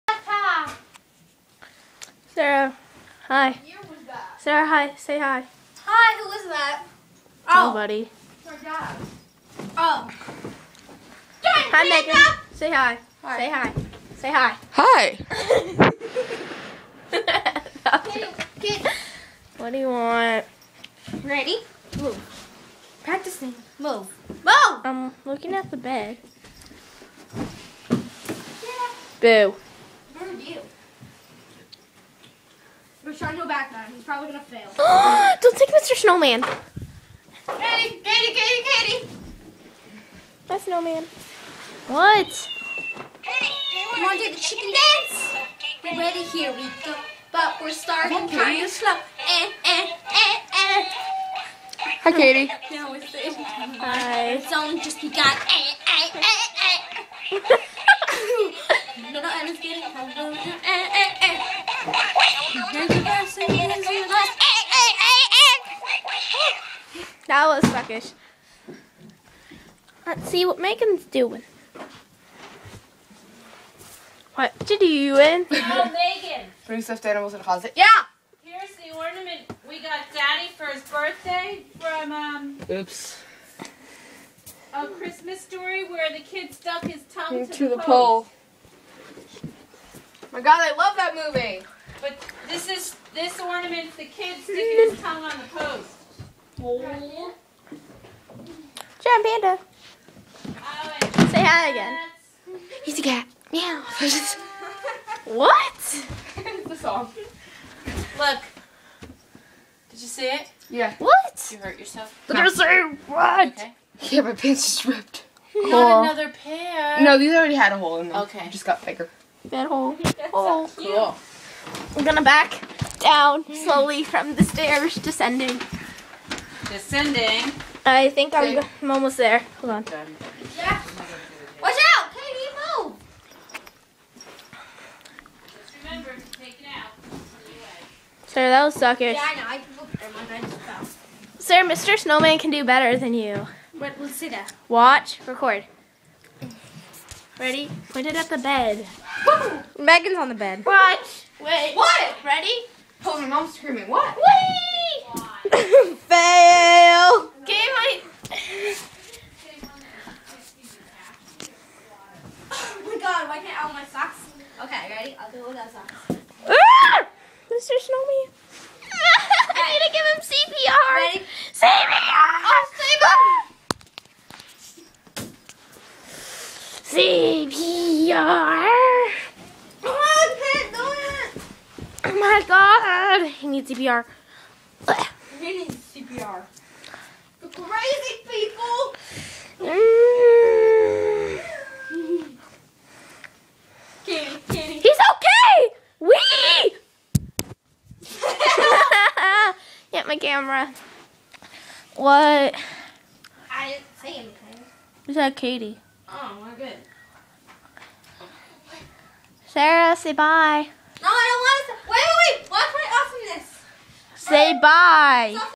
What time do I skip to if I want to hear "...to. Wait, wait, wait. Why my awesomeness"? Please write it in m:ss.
3:31.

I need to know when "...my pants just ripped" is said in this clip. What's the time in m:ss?
1:54.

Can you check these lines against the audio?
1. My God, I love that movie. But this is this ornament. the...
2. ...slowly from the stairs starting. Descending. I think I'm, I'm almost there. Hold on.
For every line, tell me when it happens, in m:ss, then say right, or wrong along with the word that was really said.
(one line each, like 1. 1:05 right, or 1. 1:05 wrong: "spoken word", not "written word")
1. 1:30 right
2. 2:03 wrong: "descending", not "starting".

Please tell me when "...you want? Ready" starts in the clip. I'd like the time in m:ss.
0:19.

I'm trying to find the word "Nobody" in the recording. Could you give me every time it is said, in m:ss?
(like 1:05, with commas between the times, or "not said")
0:07.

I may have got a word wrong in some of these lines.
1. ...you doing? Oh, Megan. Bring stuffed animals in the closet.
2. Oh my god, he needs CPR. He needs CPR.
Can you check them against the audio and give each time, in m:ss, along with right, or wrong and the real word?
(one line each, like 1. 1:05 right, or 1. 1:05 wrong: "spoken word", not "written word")
1. 1:14 right
2. 3:02 right.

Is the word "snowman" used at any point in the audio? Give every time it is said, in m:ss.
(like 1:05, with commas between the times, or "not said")
0:35, 0:40, 2:21, 2:47.